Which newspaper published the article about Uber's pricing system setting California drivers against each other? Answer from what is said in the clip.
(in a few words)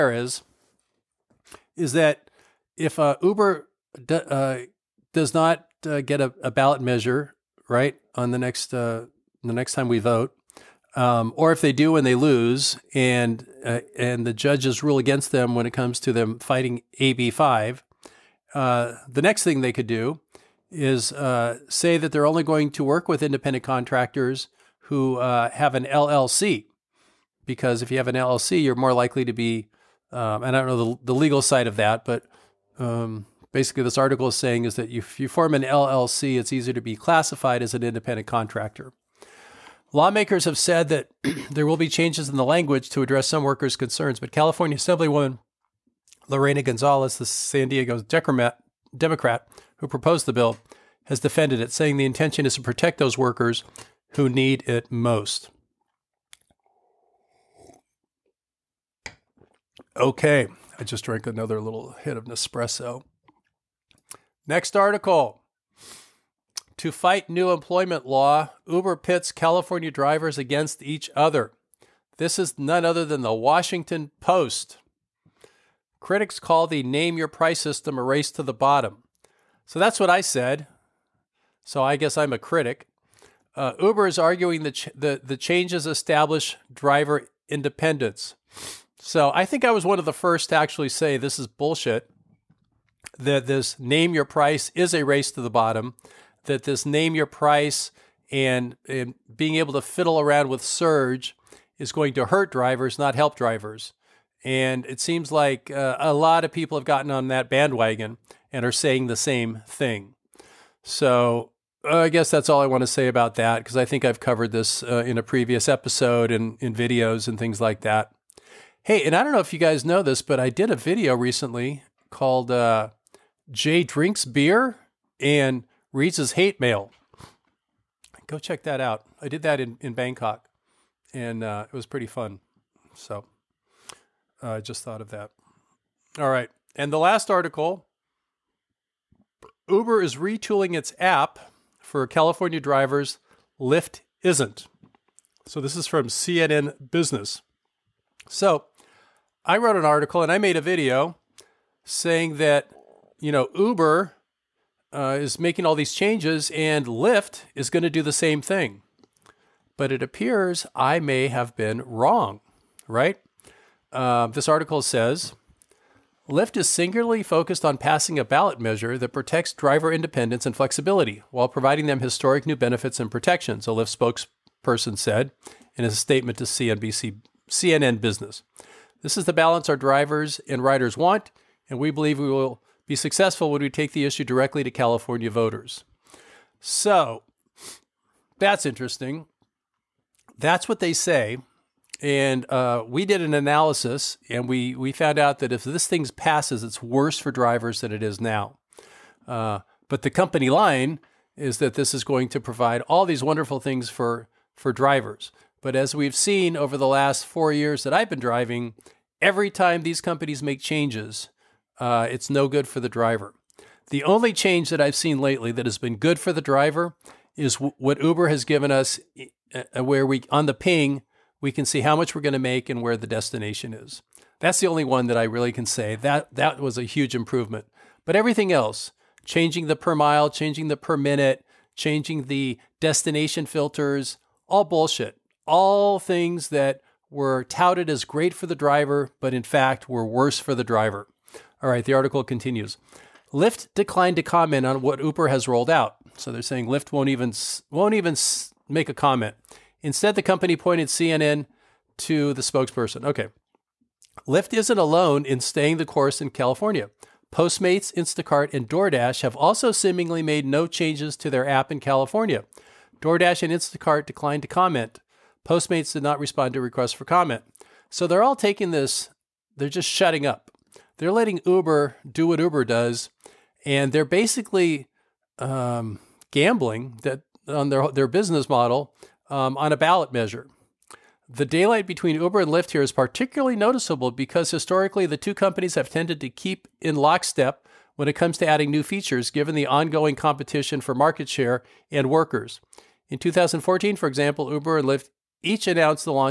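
Washington Post.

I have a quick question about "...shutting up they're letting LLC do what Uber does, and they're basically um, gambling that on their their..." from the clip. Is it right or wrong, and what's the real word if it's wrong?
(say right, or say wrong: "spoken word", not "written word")
wrong: "Uber", not "LLC".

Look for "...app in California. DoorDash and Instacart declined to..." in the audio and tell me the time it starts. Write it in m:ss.
4:21.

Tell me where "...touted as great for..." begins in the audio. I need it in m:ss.
3:57.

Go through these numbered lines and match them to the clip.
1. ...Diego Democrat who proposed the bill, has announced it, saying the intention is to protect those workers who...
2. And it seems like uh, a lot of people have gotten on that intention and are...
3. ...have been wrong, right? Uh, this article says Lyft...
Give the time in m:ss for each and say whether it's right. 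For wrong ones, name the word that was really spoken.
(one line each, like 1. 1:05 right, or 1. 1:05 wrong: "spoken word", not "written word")
1. 0:47 wrong: "defended", not "announced"
2. 1:44 wrong: "bandwagon", not "intention"
3. 2:41 right.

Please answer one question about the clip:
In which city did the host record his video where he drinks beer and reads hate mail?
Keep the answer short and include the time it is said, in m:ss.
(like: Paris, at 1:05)
Bangkok, at 2:09.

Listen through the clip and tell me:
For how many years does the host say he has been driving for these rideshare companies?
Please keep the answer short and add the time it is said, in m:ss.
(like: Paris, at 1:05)
4, at 3:27.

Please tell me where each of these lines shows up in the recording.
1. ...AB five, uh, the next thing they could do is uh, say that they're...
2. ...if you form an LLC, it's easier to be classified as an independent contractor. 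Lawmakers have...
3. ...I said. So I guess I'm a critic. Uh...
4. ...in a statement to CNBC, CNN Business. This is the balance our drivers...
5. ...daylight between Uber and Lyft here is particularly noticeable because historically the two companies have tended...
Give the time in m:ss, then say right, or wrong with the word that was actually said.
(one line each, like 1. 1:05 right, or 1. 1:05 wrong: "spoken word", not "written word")
1. 0:16 right
2. 0:34 right
3. 1:20 right
4. 2:55 right
5. 4:41 right.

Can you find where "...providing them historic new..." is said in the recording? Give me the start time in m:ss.
2:51.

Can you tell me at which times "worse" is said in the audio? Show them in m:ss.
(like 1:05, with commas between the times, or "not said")
3:16, 4:00.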